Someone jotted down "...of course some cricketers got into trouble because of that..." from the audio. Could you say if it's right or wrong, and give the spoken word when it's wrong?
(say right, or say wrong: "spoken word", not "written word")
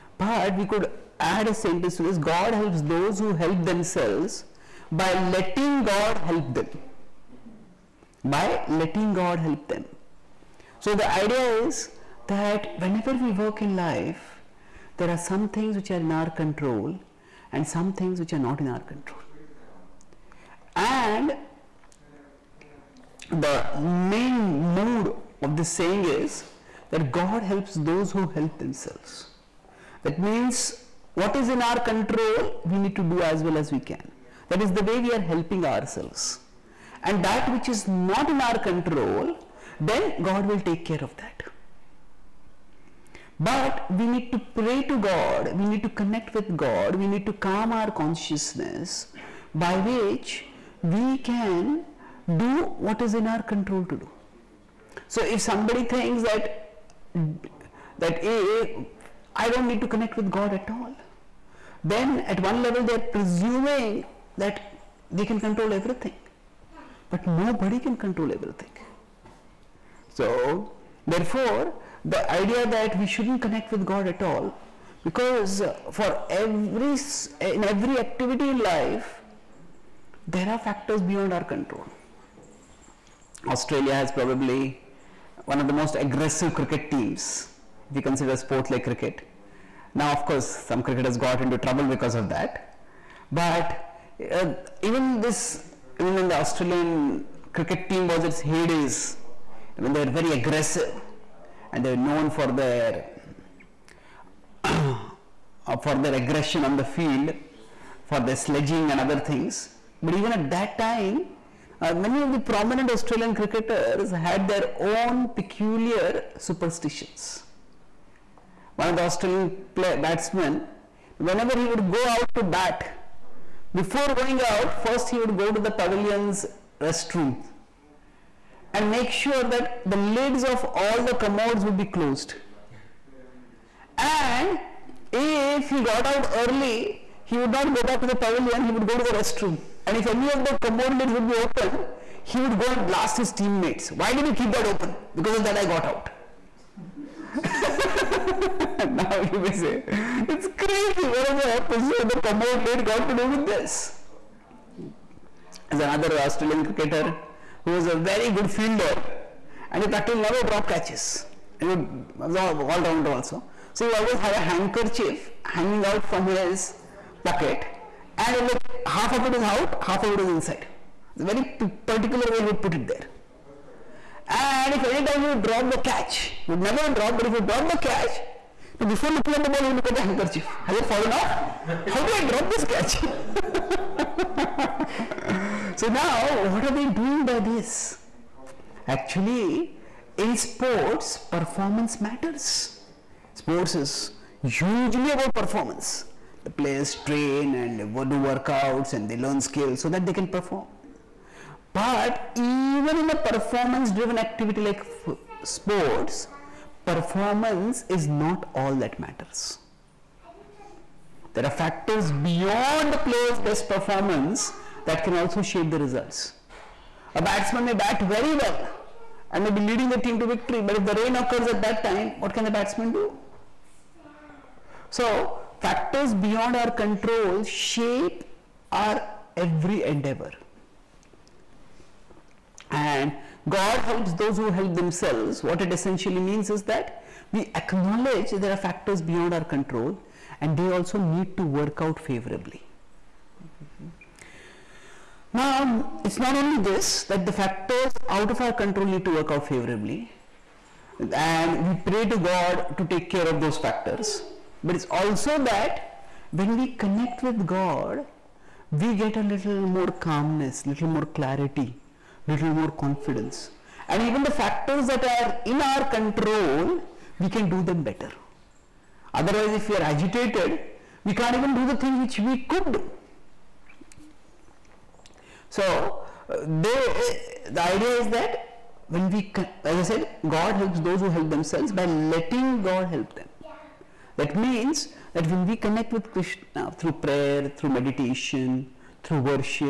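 right.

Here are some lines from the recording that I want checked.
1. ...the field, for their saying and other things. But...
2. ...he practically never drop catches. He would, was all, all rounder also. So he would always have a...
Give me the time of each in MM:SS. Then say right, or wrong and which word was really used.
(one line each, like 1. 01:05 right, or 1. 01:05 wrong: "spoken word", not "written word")
1. 01:46 wrong: "sledging", not "saying"
2. 02:39 right.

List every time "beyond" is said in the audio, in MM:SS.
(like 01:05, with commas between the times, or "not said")
01:21, 03:32, 03:46, 03:59.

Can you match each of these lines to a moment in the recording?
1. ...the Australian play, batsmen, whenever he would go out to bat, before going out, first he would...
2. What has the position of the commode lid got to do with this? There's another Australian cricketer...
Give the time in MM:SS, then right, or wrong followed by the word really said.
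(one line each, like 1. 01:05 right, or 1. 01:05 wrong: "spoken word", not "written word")
1. 01:58 right
2. 02:31 right.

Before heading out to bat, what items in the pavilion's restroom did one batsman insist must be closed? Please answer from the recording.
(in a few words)
commode lids.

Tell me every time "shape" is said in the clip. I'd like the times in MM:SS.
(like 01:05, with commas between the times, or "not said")
03:35, 03:47.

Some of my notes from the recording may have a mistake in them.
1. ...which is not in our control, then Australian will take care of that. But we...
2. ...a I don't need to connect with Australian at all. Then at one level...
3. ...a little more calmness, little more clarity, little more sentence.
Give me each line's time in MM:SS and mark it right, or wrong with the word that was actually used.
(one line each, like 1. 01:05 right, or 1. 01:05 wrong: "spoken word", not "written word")
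1. 00:37 wrong: "God", not "Australian"
2. 00:58 wrong: "God", not "Australian"
3. 04:19 wrong: "confidence", not "sentence".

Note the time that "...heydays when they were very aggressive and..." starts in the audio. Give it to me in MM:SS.
01:38.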